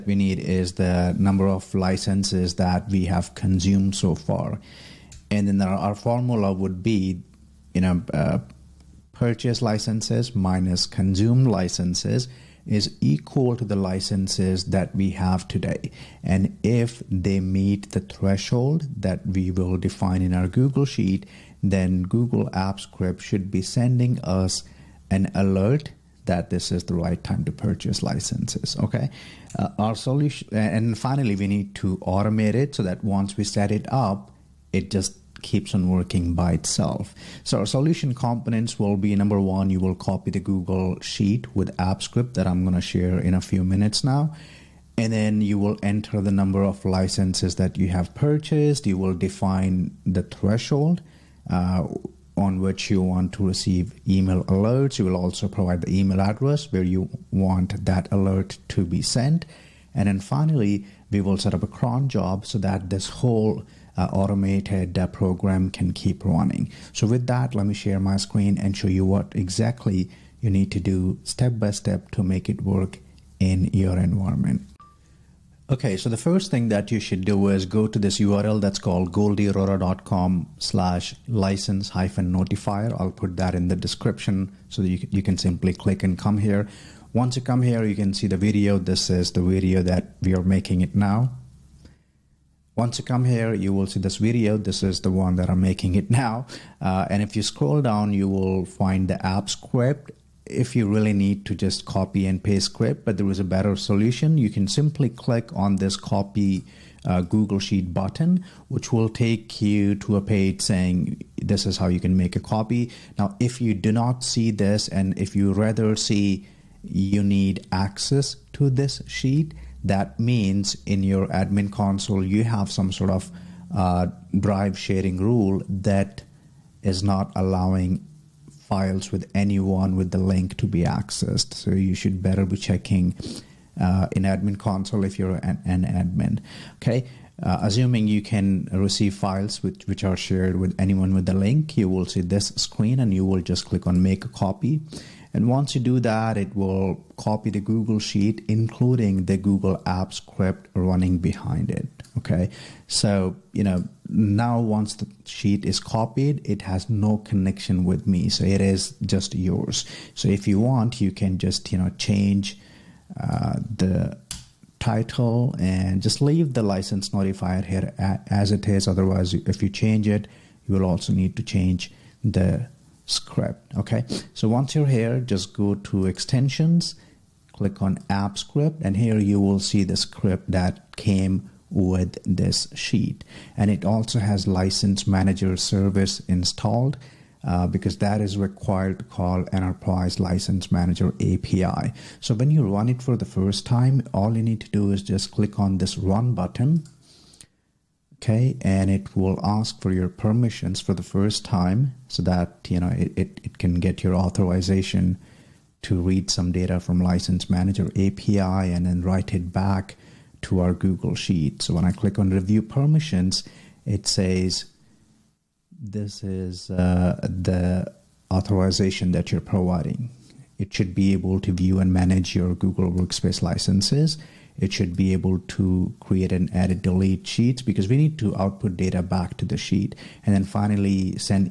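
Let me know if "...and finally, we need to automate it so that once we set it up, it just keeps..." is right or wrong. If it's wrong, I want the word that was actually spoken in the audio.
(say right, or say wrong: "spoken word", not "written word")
right.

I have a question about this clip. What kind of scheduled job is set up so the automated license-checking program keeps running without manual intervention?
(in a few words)
cron job.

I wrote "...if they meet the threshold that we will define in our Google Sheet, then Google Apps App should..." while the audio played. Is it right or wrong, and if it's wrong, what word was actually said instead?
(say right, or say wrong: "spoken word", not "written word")
wrong: "Script", not "App".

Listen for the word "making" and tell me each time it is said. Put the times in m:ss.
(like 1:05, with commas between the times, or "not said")
1:30, 1:35.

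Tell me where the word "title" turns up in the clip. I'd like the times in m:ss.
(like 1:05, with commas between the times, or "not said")
2:44.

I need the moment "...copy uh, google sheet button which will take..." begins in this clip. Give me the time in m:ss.
1:45.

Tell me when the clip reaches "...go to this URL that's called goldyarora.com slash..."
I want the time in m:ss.
1:17.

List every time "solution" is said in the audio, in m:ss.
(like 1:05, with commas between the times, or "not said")
0:29, 0:37, 1:43.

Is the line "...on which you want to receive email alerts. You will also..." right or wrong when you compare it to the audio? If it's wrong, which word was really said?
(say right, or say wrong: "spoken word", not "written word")
right.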